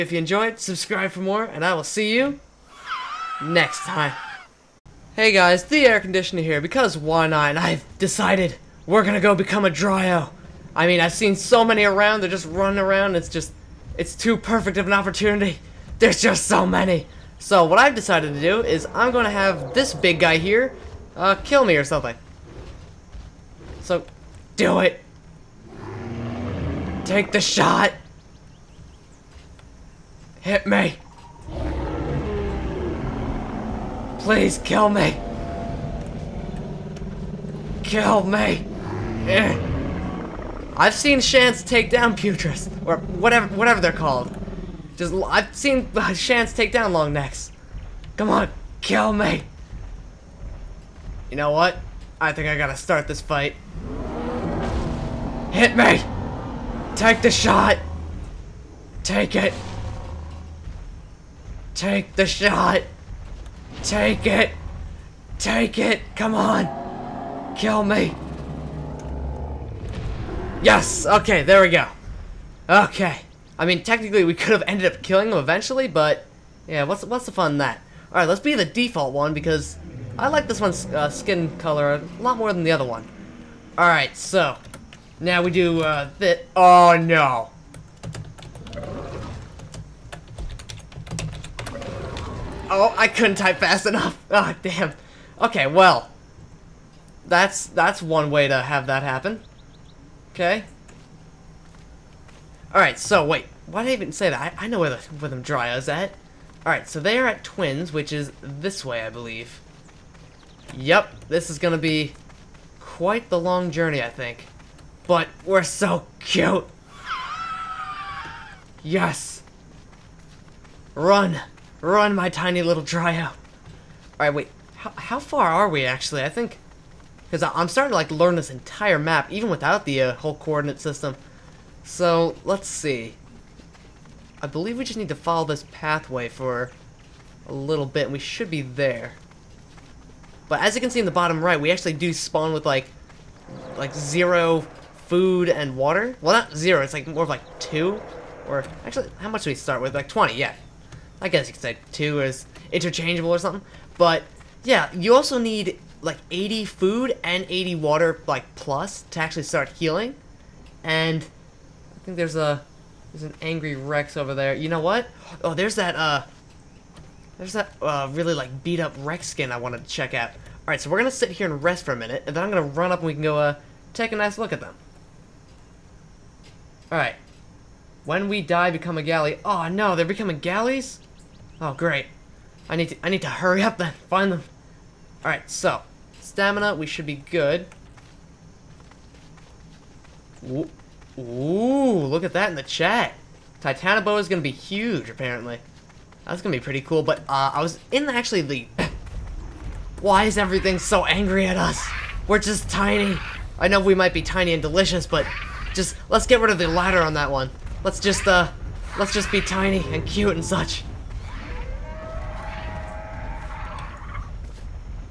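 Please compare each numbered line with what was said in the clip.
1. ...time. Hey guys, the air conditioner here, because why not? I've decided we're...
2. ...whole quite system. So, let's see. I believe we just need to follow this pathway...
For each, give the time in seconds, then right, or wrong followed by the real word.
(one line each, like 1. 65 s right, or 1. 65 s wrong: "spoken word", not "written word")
1. 3 s right
2. 130 s wrong: "coordinate", not "quite".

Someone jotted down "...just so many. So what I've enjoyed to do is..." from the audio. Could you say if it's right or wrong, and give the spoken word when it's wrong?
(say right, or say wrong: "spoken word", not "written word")
wrong: "decided", not "enjoyed".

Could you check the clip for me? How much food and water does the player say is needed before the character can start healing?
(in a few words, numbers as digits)
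80.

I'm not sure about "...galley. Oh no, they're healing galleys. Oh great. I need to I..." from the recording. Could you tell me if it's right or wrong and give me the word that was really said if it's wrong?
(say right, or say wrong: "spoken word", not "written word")
wrong: "becoming", not "healing".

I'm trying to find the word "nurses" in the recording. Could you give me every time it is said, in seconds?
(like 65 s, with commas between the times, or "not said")
not said.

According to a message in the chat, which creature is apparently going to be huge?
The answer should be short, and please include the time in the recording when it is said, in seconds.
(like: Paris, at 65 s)
Titanoboa, at 193 s.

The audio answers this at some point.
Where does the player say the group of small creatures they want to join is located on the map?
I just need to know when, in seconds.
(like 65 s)
107 s.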